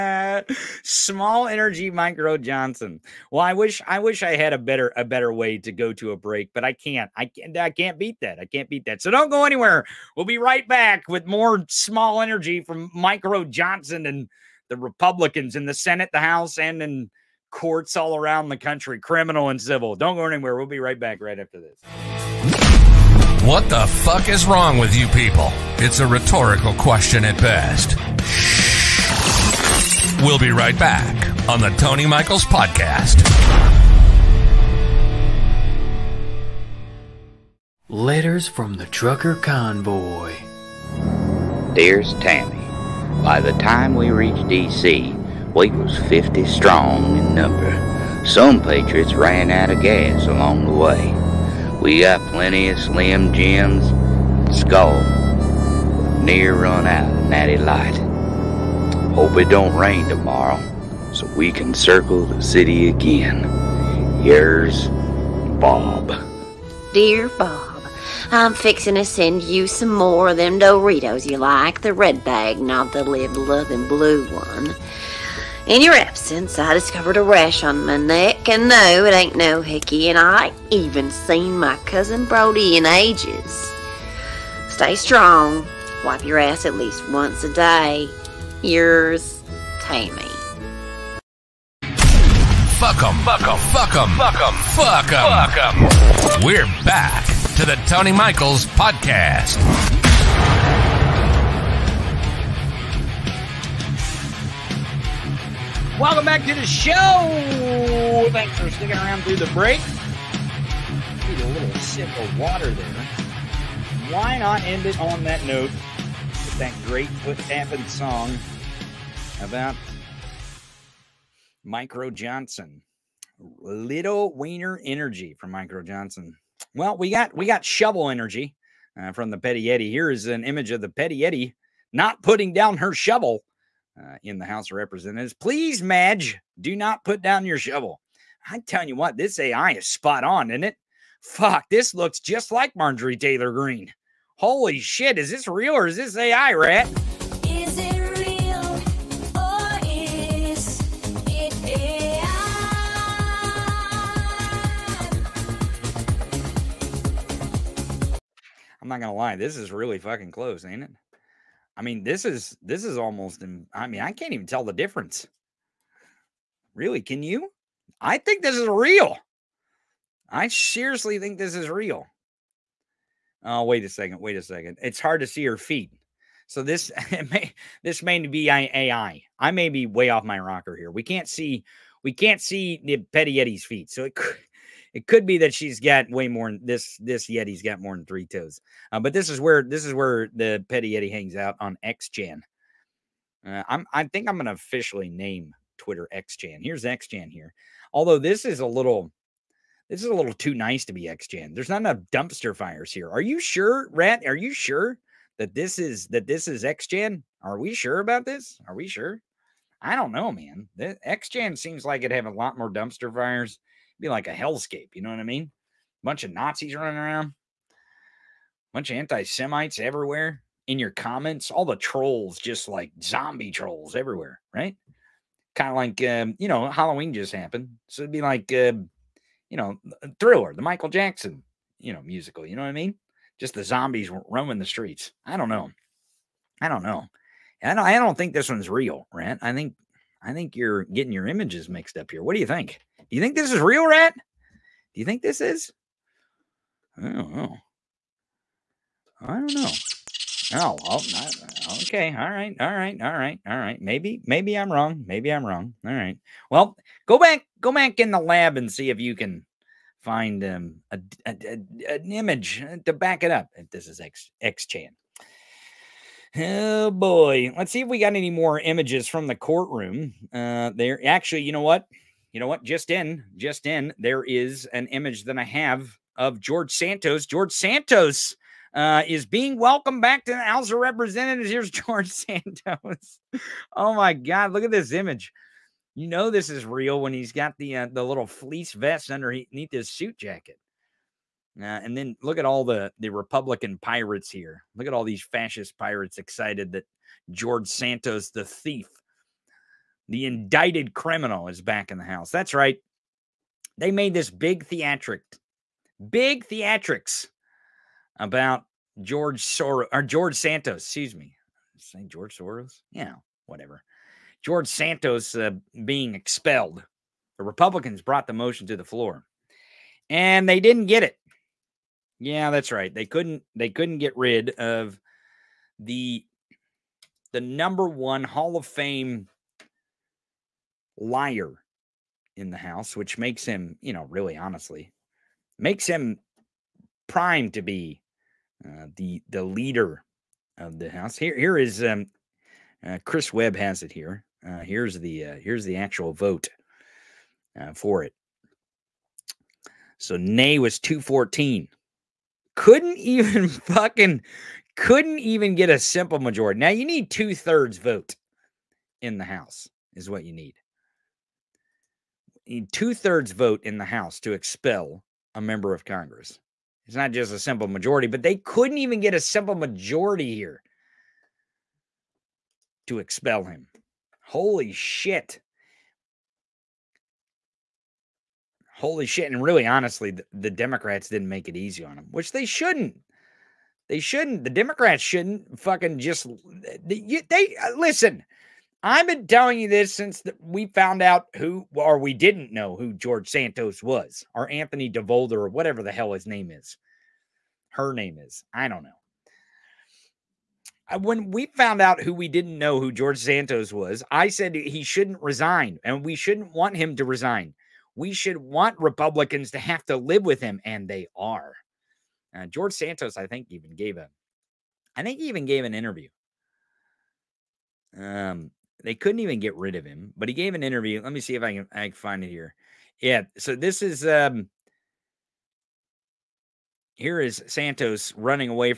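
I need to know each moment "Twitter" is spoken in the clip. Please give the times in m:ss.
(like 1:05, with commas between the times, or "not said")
3:15.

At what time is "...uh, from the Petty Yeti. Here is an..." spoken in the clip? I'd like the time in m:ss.
2:09.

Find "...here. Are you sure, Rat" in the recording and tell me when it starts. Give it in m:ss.
3:22.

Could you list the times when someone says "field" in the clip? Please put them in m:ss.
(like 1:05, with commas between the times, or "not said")
not said.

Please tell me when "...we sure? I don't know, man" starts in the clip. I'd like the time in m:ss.
3:28.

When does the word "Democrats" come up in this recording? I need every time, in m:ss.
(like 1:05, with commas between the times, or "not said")
6:20, 6:24.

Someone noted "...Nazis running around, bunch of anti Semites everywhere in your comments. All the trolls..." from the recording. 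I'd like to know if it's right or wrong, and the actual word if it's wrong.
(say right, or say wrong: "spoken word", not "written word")
right.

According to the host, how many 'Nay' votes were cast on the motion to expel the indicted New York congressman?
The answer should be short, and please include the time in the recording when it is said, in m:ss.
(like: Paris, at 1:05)
214, at 5:50.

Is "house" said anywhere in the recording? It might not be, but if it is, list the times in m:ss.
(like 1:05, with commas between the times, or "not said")
0:16, 2:14, 4:40, 5:02, 5:32, 5:40, 5:59, 6:03.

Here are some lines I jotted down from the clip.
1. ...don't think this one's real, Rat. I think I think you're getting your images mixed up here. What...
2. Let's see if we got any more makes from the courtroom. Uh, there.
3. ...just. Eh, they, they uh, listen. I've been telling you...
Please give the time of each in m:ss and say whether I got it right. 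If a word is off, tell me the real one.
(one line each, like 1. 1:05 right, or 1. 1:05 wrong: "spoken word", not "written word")
1. 3:58 right
2. 4:27 wrong: "images", not "makes"
3. 6:25 right.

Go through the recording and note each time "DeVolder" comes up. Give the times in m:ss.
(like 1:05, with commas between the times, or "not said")
6:34.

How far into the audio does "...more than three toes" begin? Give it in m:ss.
3:07.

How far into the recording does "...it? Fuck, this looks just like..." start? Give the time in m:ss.
2:20.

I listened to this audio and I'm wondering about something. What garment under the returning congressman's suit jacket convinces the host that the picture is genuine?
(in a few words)
fleece vest.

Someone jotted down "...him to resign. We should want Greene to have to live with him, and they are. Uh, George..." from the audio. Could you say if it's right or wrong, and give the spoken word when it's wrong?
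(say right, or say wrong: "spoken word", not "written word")
wrong: "Republicans", not "Greene".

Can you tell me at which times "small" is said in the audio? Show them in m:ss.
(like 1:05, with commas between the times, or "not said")
0:00, 0:11.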